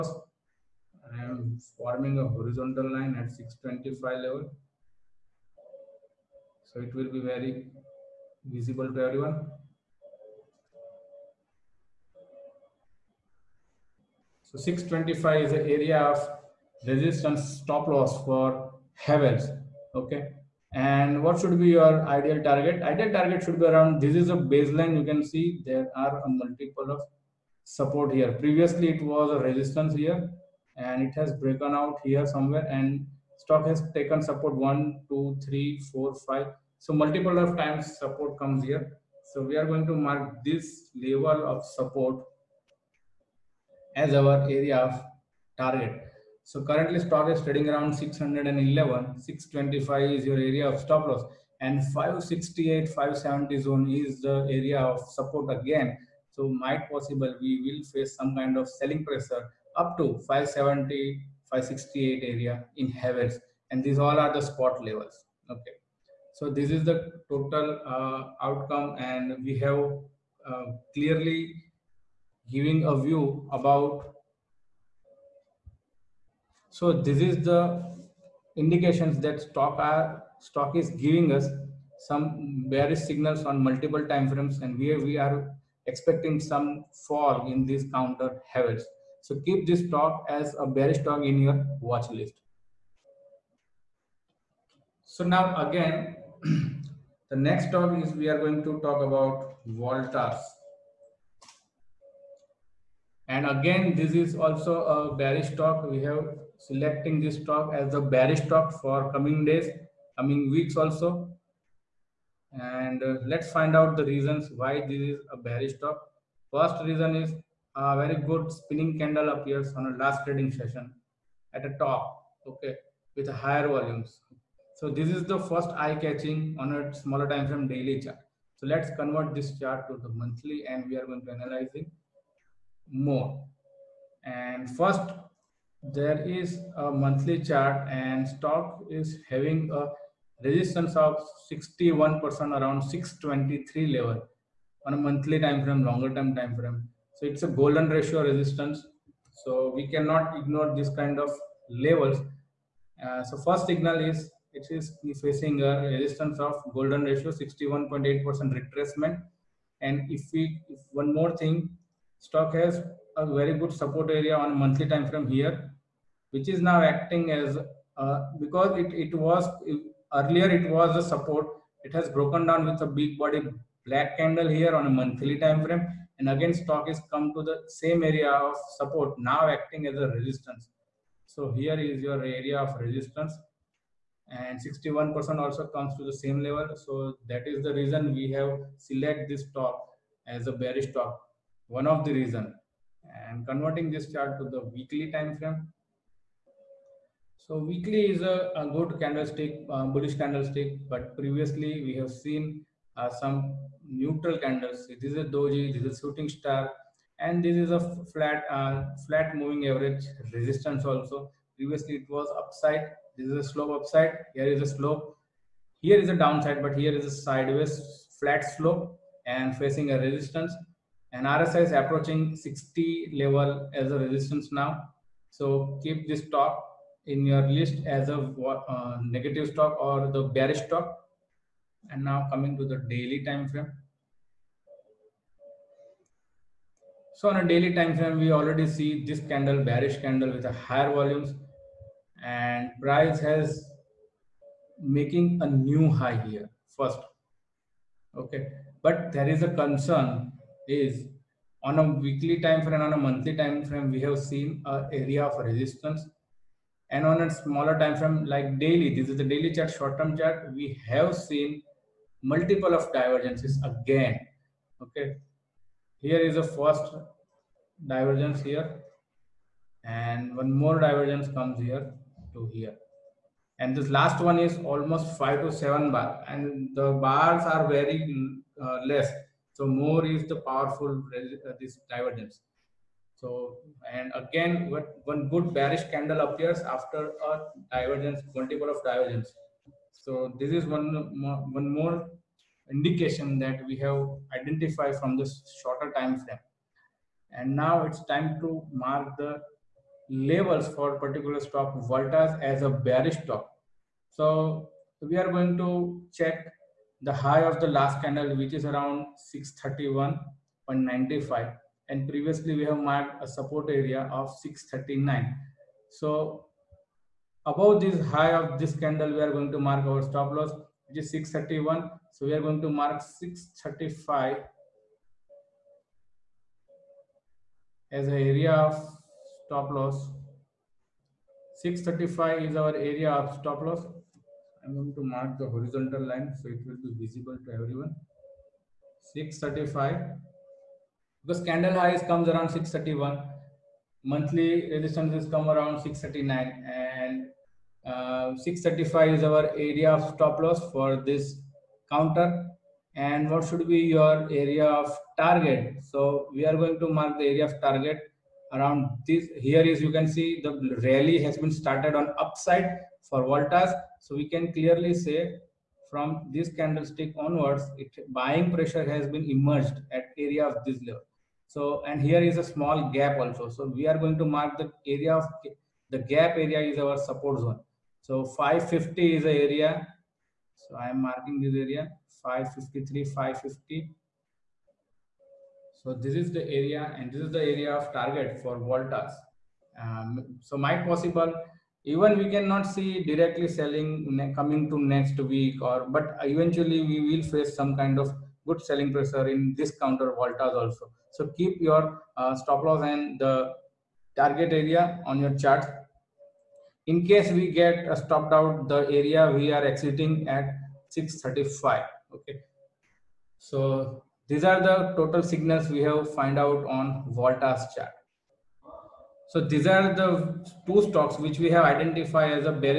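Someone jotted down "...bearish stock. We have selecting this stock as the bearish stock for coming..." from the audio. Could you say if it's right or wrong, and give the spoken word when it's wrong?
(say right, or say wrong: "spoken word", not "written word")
right.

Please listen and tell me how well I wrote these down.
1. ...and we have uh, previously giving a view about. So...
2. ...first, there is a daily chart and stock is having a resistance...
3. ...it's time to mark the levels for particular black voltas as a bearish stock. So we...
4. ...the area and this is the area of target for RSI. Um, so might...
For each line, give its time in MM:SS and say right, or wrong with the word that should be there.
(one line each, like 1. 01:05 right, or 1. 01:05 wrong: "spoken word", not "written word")
1. 01:08 wrong: "clearly", not "previously"
2. 02:14 wrong: "monthly", not "daily"
3. 04:57 wrong: "stock", not "black"
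4. 06:26 wrong: "Voltas", not "RSI".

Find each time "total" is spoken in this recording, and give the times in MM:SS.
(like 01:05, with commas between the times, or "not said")
01:07, 06:54.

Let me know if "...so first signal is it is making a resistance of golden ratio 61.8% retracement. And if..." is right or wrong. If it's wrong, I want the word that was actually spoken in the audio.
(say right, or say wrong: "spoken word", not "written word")
wrong: "facing", not "making".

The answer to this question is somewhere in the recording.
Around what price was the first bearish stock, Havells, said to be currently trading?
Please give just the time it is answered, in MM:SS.
00:47.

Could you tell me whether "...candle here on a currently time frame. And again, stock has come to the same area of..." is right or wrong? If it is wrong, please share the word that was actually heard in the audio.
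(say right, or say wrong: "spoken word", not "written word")
wrong: "monthly", not "currently".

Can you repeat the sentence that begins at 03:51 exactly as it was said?
And now coming to the daily time frame.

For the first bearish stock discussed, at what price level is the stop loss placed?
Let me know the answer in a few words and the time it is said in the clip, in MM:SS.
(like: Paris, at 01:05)
625, at 00:49.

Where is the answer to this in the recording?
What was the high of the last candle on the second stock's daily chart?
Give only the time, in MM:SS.
05:09.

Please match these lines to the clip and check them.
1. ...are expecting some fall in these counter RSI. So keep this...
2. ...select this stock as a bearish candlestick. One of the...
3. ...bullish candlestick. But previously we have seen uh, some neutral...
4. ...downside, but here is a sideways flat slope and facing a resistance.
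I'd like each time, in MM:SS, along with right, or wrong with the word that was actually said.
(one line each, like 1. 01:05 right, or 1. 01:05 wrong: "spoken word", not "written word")
1. 01:25 wrong: "Havells", not "RSI"
2. 03:08 wrong: "stock", not "candlestick"
3. 03:19 right
4. 03:36 right.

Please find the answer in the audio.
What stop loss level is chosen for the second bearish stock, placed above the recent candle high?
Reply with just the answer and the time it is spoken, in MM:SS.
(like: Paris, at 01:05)
635, at 05:23.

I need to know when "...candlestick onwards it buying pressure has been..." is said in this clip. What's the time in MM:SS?
06:06.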